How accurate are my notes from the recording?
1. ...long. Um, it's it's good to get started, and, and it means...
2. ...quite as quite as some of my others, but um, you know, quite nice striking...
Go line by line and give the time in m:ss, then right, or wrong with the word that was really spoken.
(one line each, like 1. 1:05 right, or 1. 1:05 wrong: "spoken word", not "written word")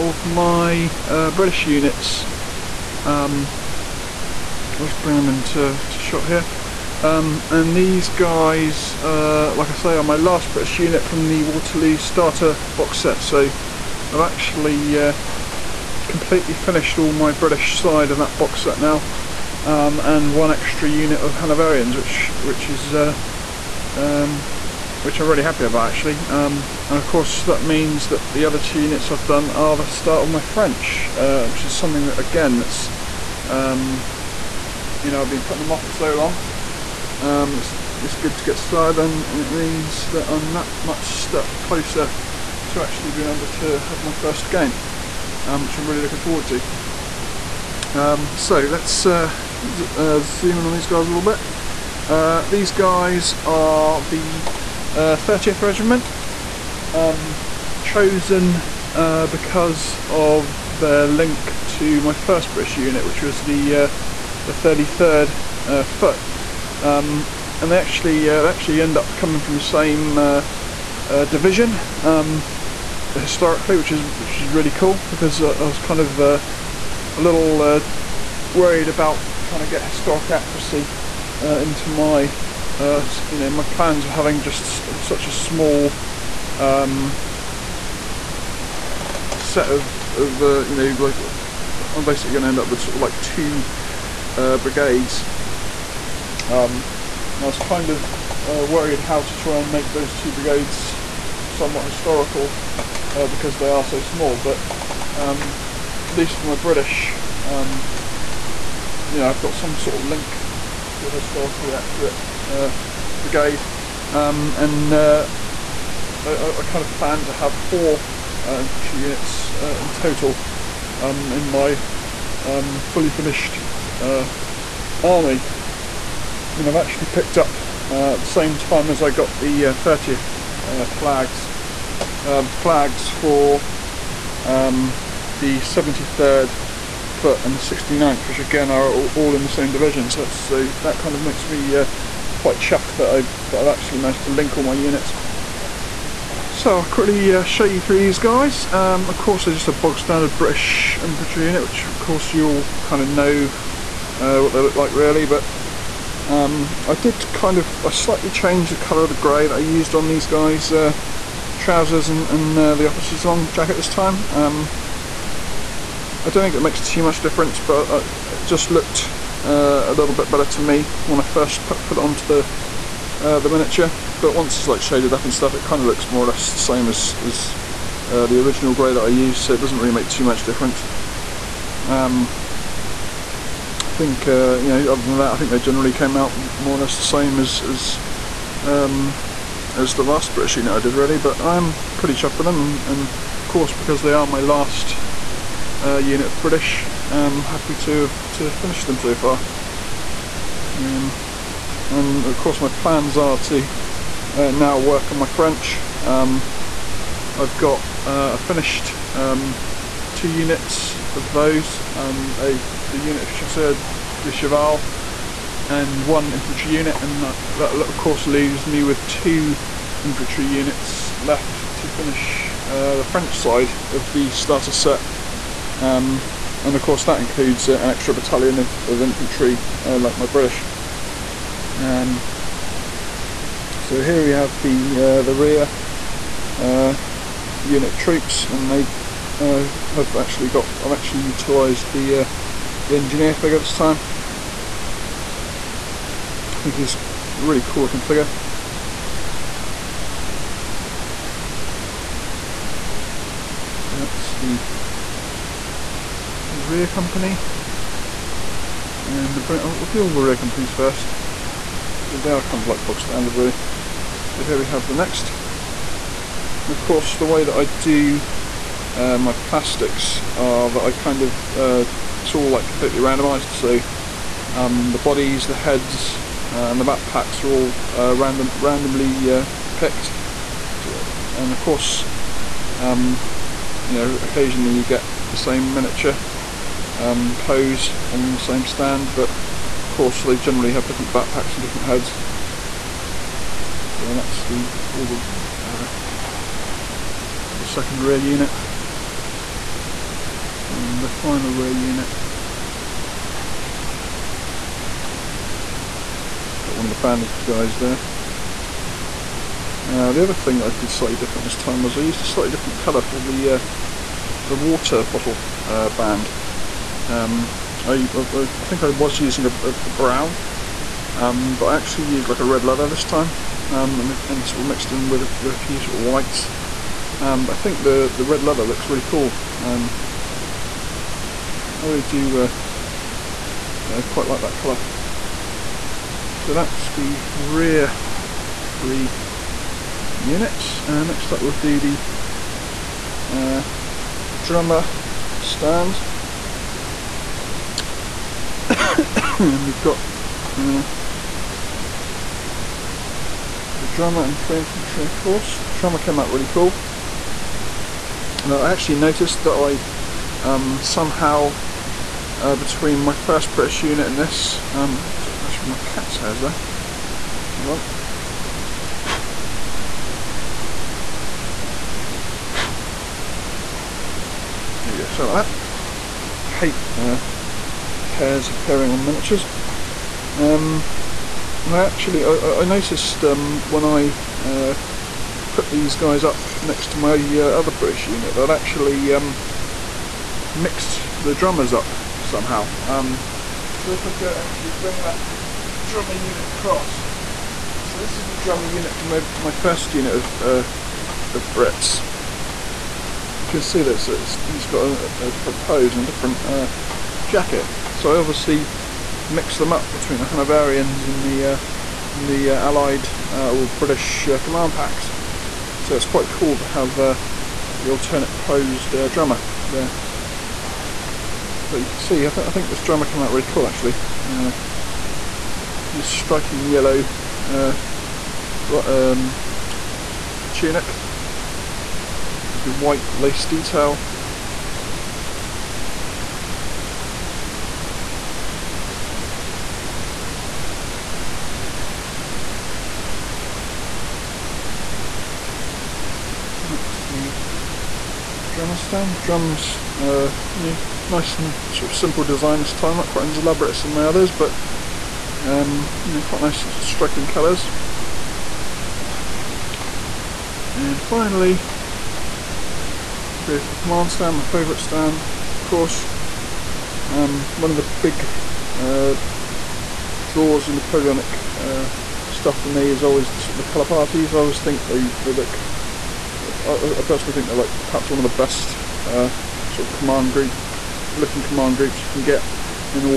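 1. 0:36 right
2. 7:33 wrong: "elaborate", not "quite".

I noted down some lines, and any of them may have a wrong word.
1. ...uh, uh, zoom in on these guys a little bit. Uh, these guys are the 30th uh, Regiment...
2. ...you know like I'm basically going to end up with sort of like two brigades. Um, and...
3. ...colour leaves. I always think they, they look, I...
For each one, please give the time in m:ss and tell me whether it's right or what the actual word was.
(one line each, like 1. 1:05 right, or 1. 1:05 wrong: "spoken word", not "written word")
1. 0:49 right
2. 1:30 right
3. 7:53 wrong: "parties", not "leaves".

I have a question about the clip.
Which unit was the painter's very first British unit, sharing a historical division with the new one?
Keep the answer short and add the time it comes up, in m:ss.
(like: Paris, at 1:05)
33rd Foot, at 1:04.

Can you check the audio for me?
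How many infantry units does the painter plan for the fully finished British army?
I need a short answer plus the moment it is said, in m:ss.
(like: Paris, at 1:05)
4, at 1:57.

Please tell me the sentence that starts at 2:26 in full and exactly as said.
So I'll quickly uh, show you through these guys.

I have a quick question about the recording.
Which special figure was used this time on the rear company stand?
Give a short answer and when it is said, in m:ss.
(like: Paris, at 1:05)
engineer, at 4:02.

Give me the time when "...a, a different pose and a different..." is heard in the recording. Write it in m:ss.
6:44.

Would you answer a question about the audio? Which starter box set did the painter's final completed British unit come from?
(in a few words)
Waterloo.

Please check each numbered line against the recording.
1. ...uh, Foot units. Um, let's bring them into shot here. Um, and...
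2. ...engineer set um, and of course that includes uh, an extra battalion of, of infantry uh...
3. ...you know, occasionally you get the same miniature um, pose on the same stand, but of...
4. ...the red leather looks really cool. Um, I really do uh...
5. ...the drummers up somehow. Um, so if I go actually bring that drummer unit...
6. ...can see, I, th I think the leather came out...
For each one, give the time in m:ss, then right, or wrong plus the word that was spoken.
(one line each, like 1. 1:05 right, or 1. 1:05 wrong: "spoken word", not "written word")
1. 0:01 wrong: "British", not "Foot"
2. 3:44 wrong: "starter", not "engineer"
3. 4:43 right
4. 5:28 right
5. 6:31 right
6. 7:01 wrong: "drummer", not "leather".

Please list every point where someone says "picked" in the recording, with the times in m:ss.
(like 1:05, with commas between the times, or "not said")
2:07, 4:39.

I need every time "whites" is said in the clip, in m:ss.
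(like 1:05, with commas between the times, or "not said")
5:26, 7:12.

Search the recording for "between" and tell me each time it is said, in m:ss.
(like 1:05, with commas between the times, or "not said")
6:02, 6:49.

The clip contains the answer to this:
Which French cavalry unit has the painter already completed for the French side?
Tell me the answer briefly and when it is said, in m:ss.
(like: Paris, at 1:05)
Chasseur de Cheval, at 3:33.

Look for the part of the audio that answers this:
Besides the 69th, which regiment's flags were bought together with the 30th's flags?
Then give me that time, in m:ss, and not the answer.
2:15.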